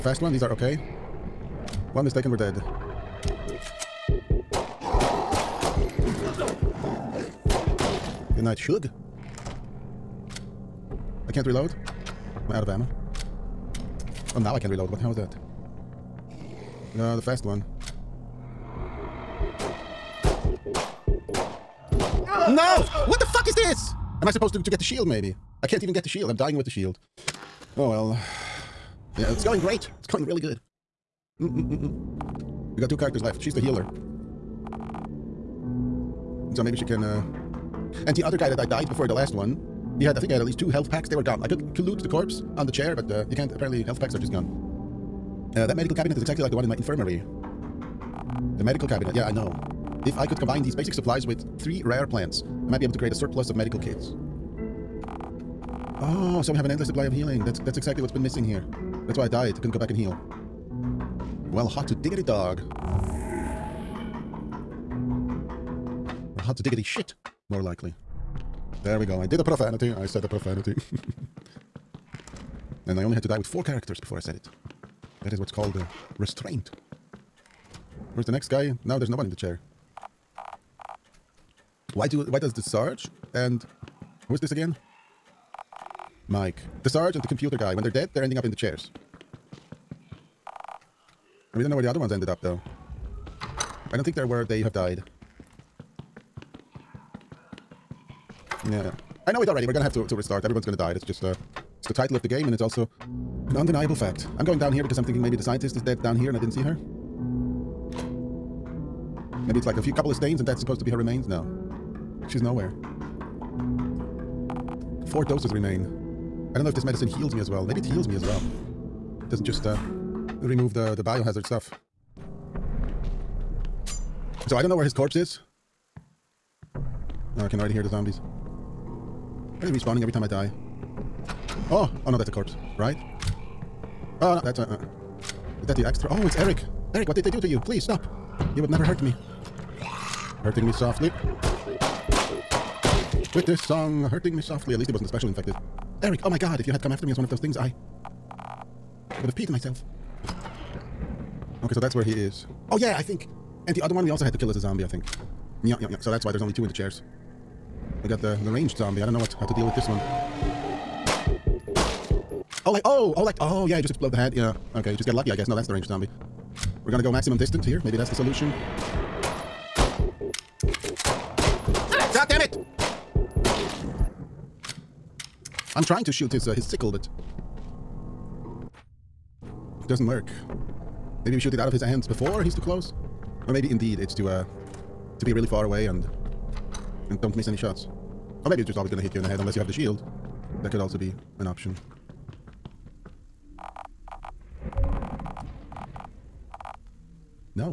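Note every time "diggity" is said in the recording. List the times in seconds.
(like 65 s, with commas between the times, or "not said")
61 s, 66 s.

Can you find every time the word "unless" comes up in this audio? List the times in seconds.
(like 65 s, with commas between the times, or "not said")
189 s.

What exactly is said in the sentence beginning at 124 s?
So I don't know where his corpse is.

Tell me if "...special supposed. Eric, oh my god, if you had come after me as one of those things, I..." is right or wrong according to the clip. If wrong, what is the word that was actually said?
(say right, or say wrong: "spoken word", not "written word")
wrong: "infected", not "supposed".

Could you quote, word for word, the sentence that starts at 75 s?
That is what's called uh, restraint.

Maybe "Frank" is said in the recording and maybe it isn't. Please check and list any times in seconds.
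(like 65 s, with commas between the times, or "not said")
not said.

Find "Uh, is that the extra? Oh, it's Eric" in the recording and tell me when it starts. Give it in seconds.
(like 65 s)
134 s.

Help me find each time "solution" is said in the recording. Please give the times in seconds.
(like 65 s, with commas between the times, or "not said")
168 s.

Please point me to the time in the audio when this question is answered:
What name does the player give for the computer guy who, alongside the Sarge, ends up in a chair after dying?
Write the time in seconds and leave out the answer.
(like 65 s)
86 s.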